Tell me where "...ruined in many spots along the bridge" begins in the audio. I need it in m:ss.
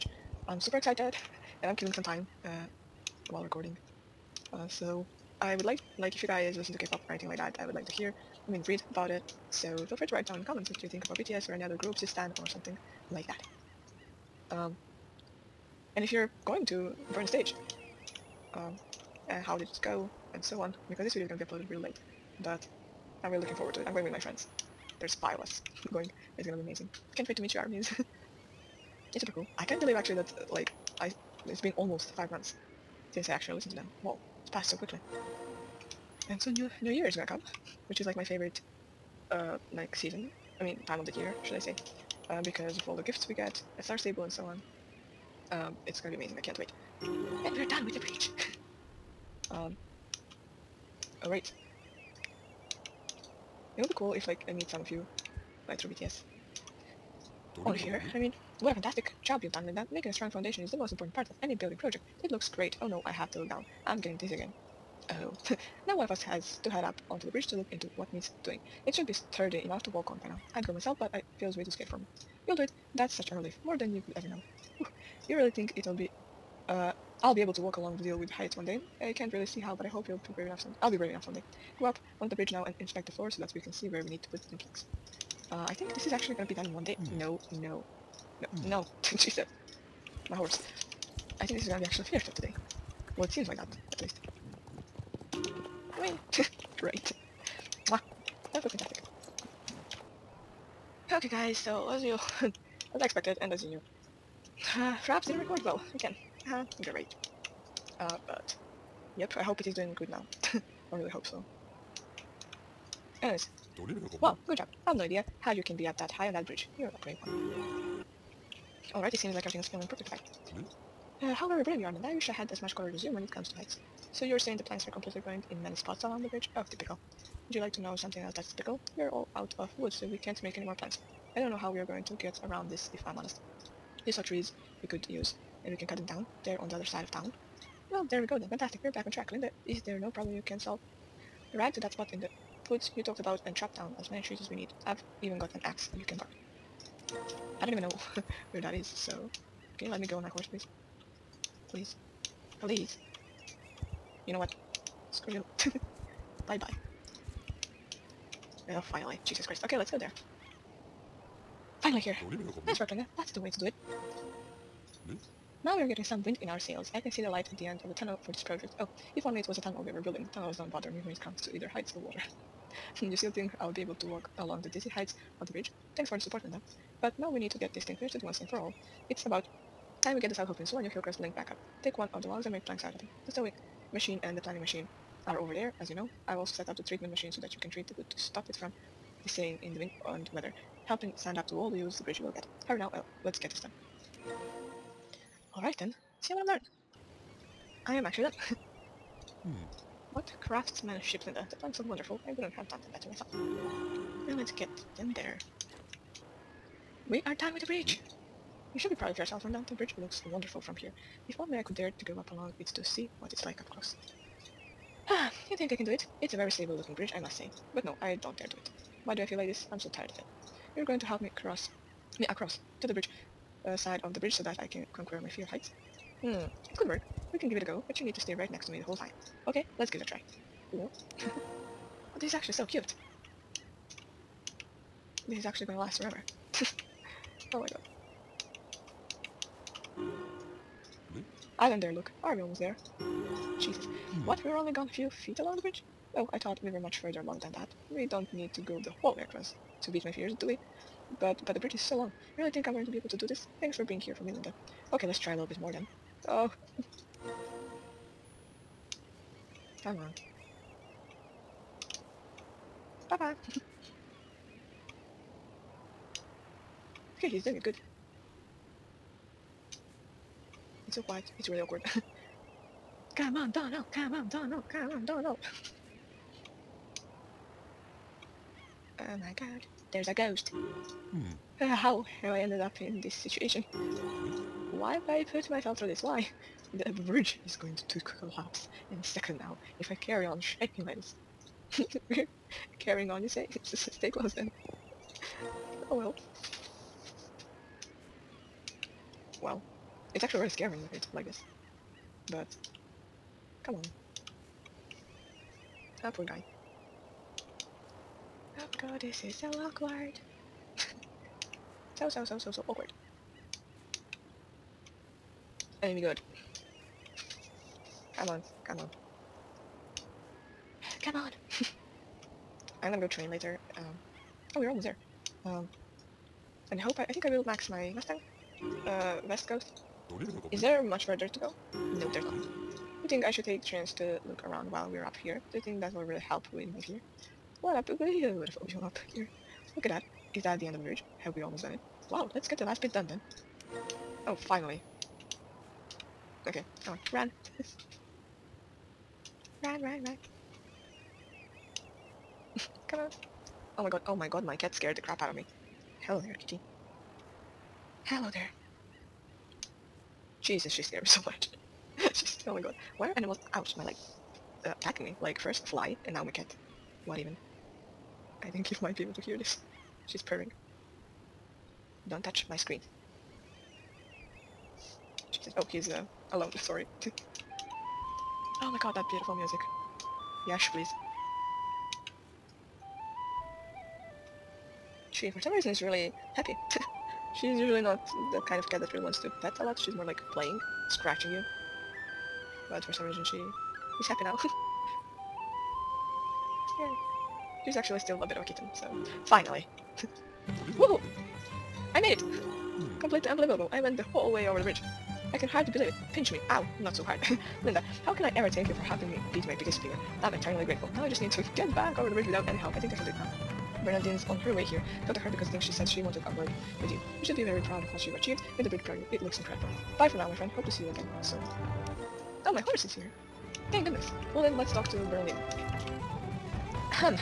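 2:05.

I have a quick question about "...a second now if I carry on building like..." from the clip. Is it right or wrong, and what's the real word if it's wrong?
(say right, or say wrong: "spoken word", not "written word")
wrong: "shaking", not "building".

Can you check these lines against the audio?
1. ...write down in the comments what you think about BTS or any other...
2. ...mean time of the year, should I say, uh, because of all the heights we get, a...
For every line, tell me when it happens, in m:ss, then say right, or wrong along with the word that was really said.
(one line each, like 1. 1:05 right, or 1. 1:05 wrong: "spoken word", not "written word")
1. 0:10 right
2. 0:40 wrong: "gifts", not "heights".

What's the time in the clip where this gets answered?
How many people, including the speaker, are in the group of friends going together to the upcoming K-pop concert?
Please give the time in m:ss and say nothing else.
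0:24.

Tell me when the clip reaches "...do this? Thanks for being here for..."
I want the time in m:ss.
4:13.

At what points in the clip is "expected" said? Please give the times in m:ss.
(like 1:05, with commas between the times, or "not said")
1:43.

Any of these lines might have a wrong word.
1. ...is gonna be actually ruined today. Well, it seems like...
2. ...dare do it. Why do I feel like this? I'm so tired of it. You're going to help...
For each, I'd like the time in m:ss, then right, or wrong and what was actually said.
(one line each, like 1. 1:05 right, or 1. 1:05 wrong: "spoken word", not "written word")
1. 1:31 wrong: "finished", not "ruined"
2. 3:38 right.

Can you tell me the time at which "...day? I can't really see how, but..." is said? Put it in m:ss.
1:18.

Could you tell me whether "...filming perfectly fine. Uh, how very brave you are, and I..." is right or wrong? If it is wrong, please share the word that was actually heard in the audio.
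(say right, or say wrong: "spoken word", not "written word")
right.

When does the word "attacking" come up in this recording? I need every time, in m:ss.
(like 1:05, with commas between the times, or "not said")
6:04.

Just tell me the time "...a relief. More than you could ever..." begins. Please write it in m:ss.
1:13.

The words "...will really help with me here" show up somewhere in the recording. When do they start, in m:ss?
5:35.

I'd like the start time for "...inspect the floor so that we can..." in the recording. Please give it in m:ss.
1:22.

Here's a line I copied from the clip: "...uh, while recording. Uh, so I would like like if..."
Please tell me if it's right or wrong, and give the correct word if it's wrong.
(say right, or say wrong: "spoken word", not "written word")
right.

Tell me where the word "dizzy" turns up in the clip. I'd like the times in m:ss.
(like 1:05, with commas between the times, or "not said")
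1:04, 2:54.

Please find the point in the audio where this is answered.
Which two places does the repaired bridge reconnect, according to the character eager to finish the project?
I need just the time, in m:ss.
3:00.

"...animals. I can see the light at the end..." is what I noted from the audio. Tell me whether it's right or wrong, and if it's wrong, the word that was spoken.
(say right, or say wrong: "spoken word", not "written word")
wrong: "sails", not "animals".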